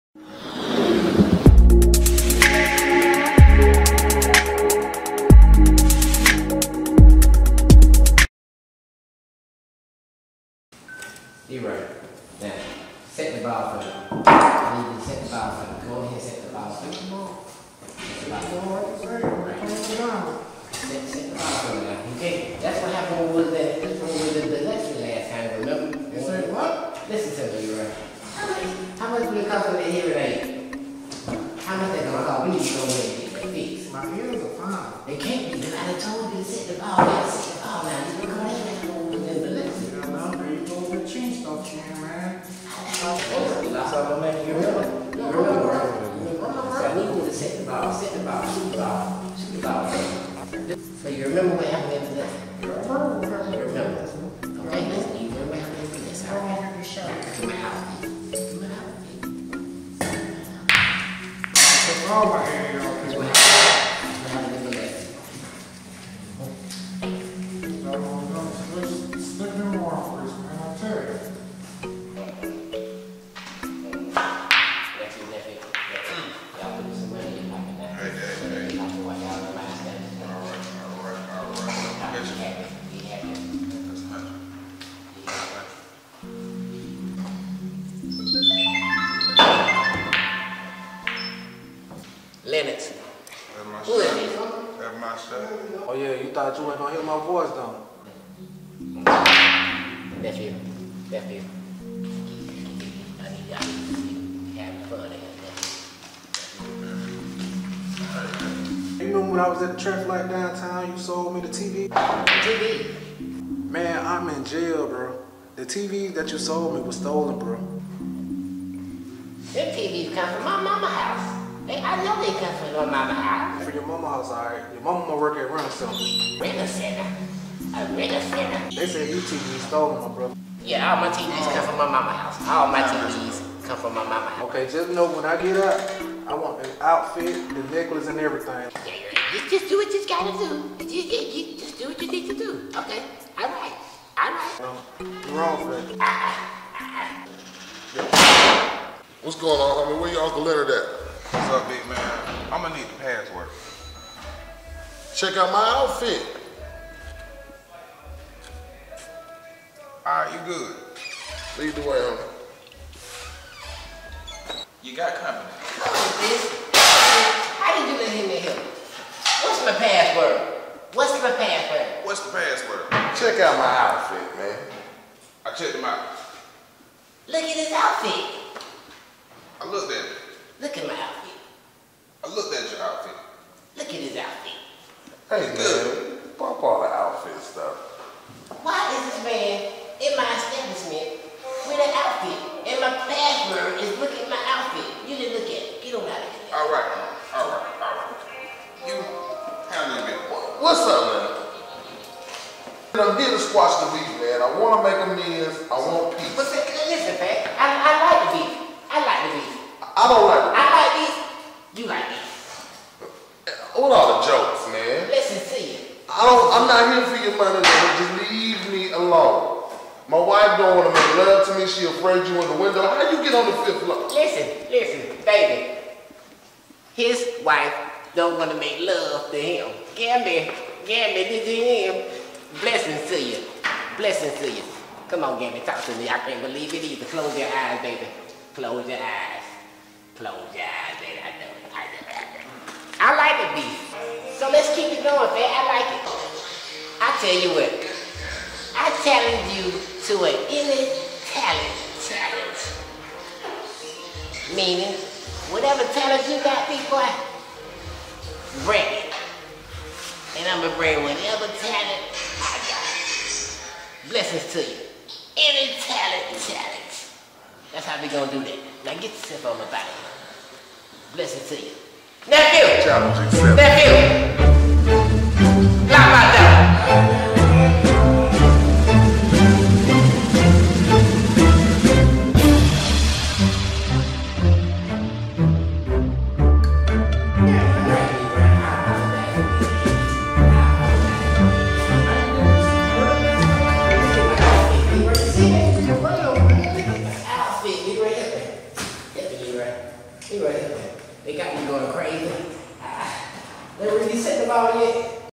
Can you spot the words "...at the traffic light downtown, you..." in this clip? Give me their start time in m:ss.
1:49.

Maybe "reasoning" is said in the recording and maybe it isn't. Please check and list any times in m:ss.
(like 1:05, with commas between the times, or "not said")
not said.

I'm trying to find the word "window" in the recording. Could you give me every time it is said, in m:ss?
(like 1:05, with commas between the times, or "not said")
3:42.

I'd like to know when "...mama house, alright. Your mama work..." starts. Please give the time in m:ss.
2:03.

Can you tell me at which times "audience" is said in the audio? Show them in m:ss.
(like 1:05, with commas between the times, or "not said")
not said.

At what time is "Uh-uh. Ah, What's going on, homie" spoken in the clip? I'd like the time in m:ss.
2:26.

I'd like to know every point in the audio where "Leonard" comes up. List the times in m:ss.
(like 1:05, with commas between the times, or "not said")
2:30.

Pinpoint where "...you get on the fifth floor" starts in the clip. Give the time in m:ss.
3:43.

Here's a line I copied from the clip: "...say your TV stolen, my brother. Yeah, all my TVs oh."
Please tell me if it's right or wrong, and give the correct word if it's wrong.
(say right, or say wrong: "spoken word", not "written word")
right.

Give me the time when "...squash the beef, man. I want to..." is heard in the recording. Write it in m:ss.
3:23.